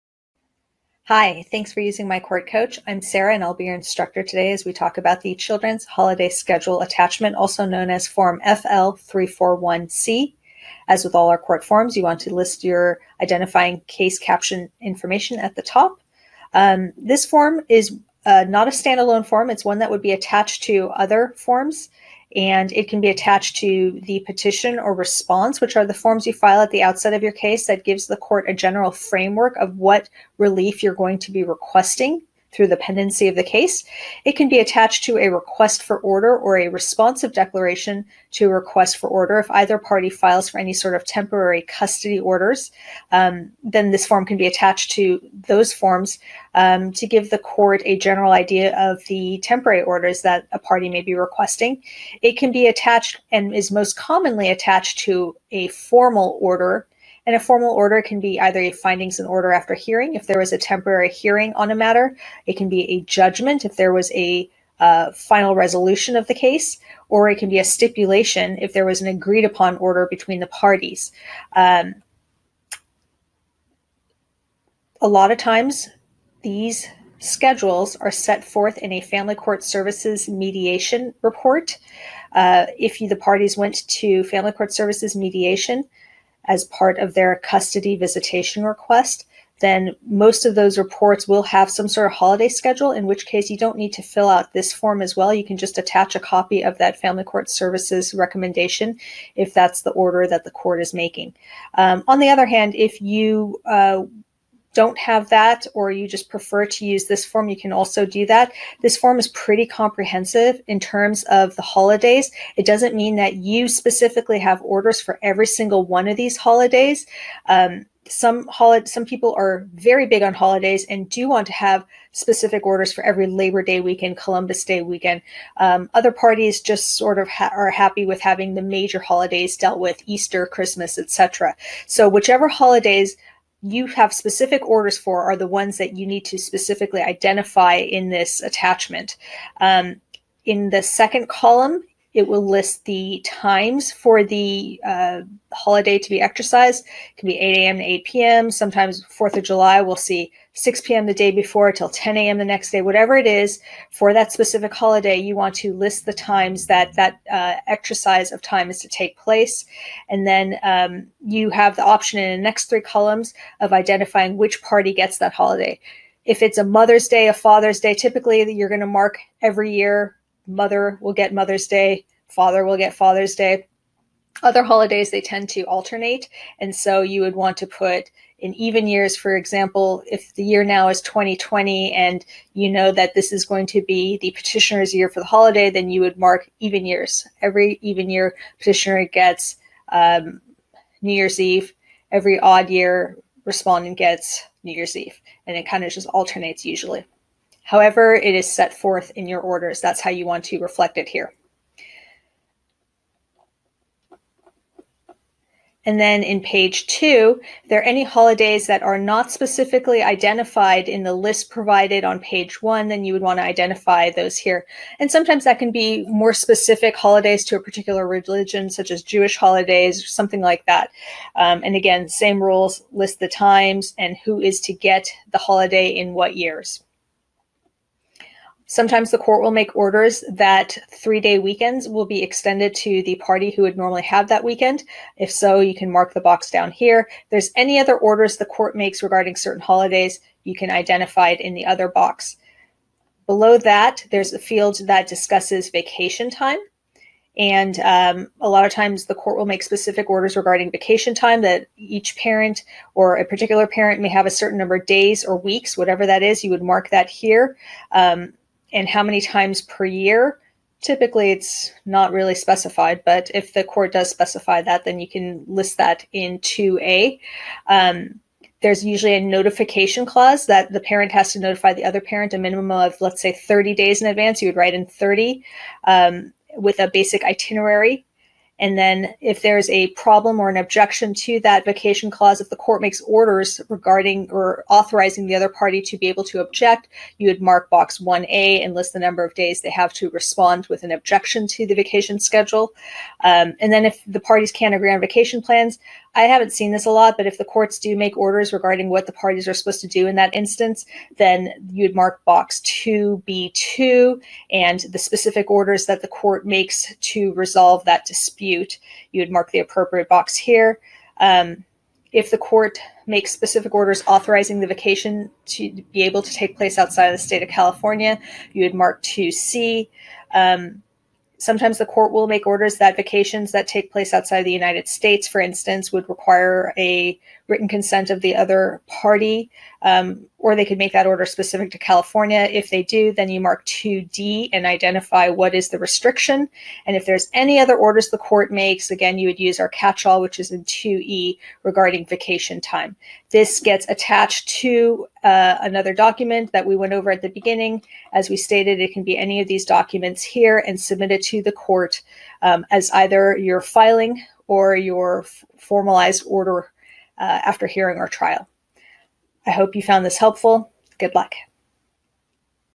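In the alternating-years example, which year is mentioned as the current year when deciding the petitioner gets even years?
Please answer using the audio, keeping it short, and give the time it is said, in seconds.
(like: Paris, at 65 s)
2020, at 181 s.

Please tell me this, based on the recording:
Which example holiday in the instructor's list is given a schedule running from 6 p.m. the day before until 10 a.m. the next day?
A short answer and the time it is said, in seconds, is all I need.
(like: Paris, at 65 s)
4th of July, at 149 s.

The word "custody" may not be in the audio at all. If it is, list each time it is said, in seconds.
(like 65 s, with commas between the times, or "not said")
41 s, 87 s.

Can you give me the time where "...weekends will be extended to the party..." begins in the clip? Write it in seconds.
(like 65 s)
231 s.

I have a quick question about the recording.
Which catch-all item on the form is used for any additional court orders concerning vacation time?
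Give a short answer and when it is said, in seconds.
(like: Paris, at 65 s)
2E, at 340 s.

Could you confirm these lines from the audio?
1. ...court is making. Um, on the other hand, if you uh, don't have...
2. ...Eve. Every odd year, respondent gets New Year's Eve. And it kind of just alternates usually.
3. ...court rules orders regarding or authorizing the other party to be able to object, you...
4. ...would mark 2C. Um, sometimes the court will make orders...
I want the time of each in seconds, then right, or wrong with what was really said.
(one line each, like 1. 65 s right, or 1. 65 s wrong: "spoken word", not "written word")
1. 100 s right
2. 191 s right
3. 282 s wrong: "makes", not "rules"
4. 318 s right.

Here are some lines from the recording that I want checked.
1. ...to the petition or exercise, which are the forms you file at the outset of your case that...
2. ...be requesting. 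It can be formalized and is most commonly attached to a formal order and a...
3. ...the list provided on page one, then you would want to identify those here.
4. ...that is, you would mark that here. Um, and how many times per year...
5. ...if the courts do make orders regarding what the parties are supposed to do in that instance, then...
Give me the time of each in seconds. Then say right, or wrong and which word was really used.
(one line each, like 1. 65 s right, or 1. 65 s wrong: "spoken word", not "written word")
1. 23 s wrong: "response", not "exercise"
2. 51 s wrong: "attached", not "formalized"
3. 211 s right
4. 256 s right
5. 297 s right.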